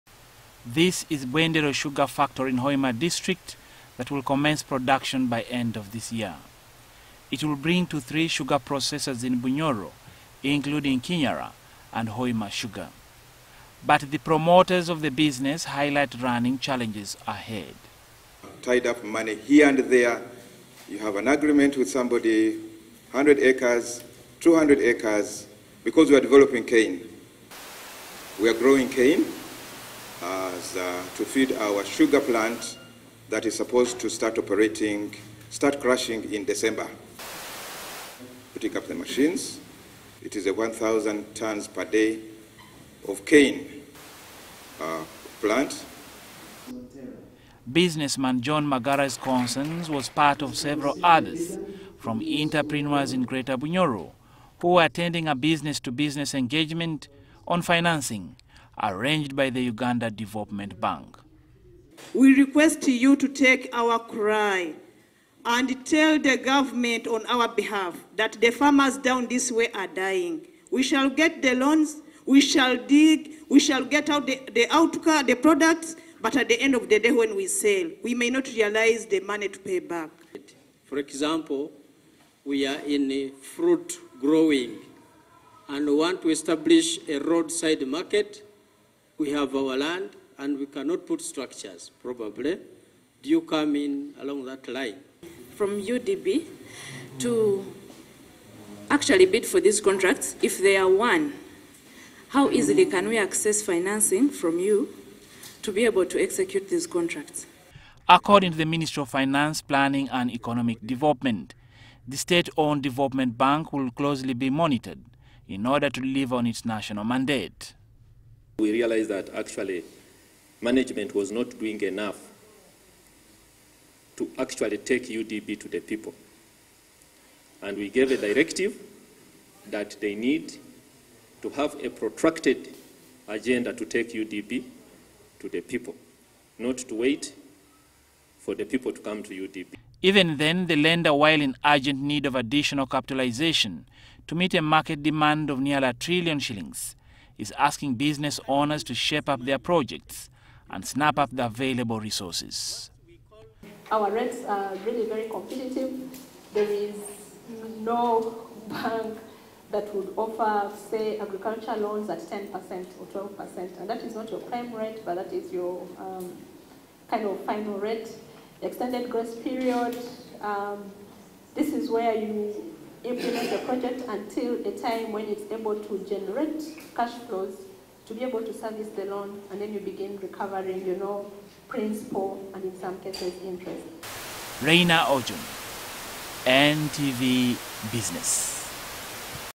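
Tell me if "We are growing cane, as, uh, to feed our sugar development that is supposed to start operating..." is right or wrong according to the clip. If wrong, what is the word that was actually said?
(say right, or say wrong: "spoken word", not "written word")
wrong: "plant", not "development".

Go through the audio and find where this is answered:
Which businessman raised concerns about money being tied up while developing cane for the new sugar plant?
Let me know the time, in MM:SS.
00:48.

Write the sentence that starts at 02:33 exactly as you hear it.
Our rents are really very competitive.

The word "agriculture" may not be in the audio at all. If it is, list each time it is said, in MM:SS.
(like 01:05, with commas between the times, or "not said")
02:41.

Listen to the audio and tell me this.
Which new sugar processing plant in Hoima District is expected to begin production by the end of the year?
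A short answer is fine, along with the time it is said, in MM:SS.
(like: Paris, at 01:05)
Bwendero Sugar Factory, at 00:01.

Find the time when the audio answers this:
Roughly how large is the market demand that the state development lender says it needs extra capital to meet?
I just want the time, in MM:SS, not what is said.
02:25.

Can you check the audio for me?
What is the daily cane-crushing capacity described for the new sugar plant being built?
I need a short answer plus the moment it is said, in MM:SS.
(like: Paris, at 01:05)
1,000 tons per day, at 00:40.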